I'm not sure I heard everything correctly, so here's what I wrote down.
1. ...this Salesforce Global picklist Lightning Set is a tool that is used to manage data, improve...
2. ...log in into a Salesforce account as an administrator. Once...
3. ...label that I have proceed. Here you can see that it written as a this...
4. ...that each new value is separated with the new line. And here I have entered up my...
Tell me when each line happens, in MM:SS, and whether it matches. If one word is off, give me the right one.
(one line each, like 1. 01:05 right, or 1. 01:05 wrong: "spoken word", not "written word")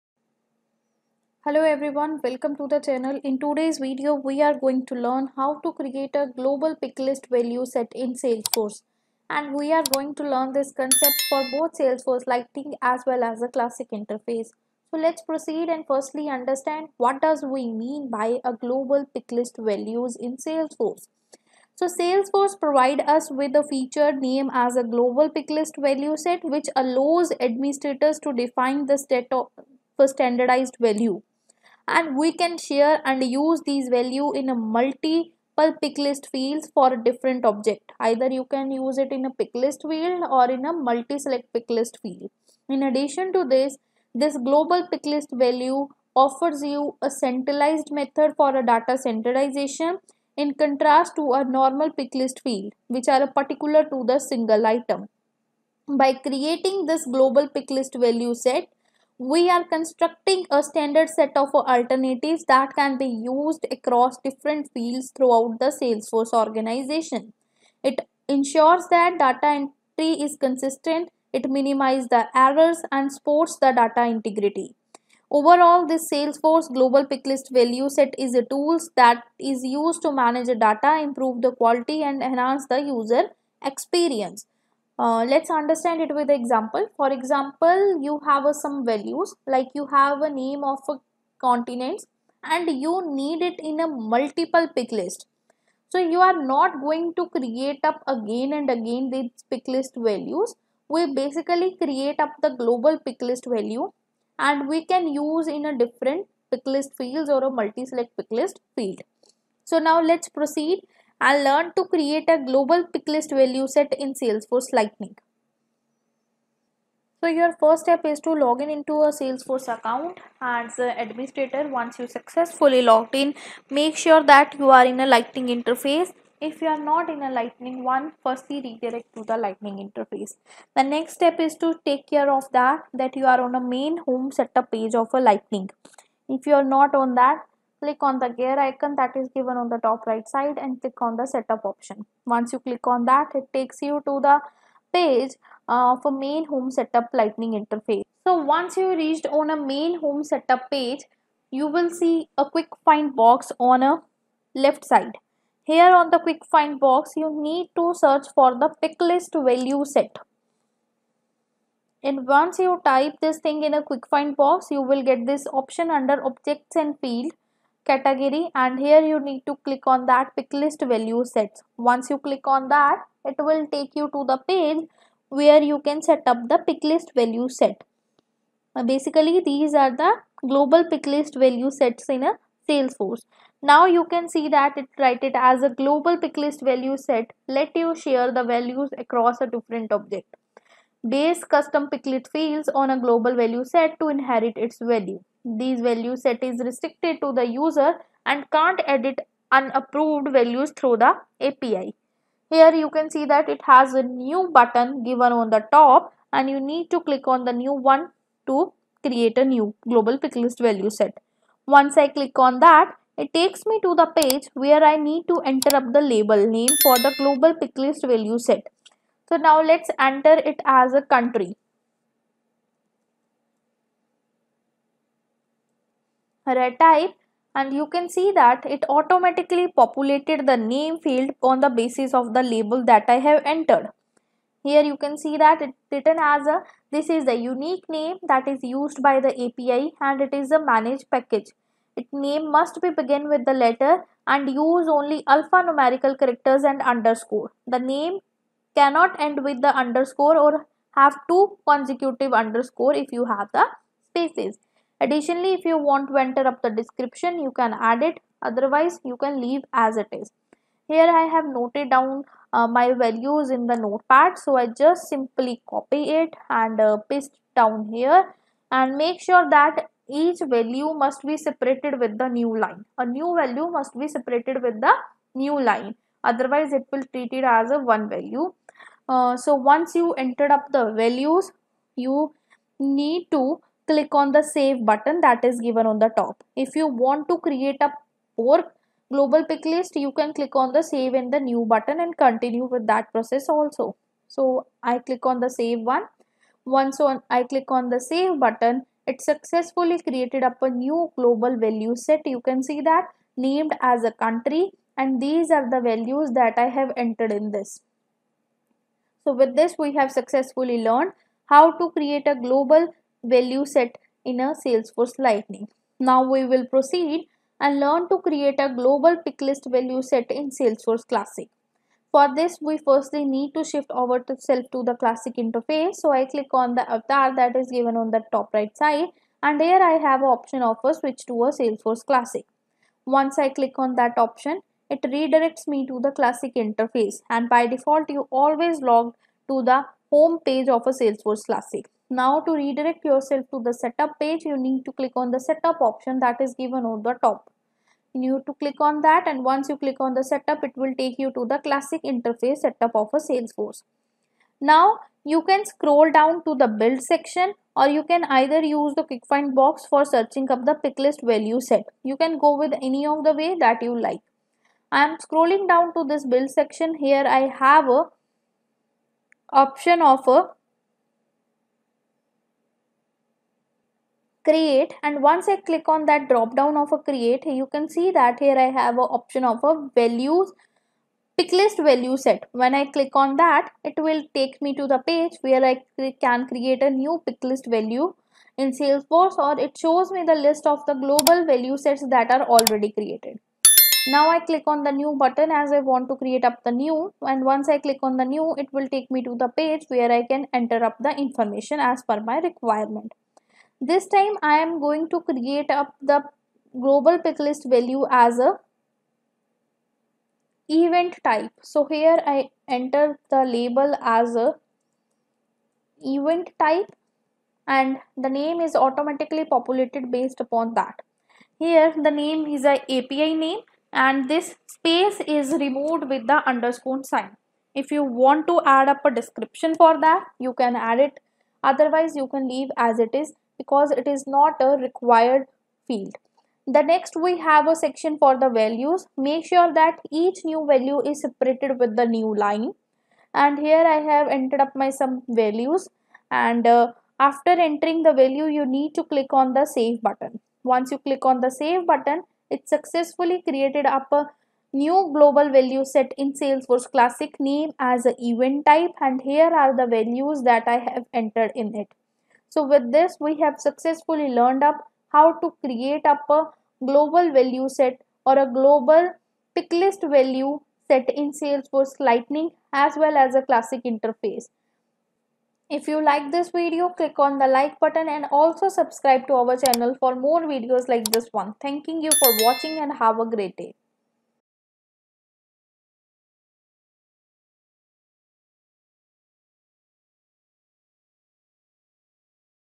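1. 01:15 wrong: "Value", not "Lightning"
2. 01:58 right
3. 03:52 wrong: "entered", not "proceed"
4. 07:19 right.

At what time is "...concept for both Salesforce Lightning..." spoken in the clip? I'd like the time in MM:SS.
00:10.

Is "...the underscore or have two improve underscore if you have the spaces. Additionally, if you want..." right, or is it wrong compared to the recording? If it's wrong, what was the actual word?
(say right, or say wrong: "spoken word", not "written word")
wrong: "consecutive", not "improve".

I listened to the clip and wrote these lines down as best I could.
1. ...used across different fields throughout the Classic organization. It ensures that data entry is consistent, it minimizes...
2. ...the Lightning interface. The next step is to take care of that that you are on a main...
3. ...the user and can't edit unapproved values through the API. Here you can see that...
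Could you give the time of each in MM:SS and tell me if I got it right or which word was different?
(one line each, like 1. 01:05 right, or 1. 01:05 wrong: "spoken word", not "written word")
1. 01:03 wrong: "Salesforce", not "Classic"
2. 02:09 right
3. 03:17 right.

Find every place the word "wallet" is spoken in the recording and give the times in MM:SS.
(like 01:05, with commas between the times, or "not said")
not said.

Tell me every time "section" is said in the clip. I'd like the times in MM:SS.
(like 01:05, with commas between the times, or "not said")
05:57, 06:06, 07:17.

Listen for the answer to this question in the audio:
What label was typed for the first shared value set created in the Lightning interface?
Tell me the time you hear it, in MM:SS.
03:41.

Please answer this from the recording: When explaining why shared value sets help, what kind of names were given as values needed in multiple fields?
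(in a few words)
Continents.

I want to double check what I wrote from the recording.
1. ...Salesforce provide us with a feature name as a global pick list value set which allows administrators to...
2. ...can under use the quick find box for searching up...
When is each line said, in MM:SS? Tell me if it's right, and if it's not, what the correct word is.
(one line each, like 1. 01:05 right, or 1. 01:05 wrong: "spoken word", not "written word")
1. 00:21 right
2. 05:58 wrong: "either", not "under".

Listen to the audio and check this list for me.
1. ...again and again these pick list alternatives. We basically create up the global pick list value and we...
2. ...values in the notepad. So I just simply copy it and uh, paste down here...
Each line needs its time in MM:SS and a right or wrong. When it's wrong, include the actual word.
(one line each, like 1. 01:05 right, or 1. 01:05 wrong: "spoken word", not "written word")
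1. 01:38 wrong: "values", not "alternatives"
2. 04:22 right.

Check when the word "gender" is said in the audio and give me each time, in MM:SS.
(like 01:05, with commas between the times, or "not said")
not said.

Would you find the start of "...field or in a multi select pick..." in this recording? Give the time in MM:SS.
00:39.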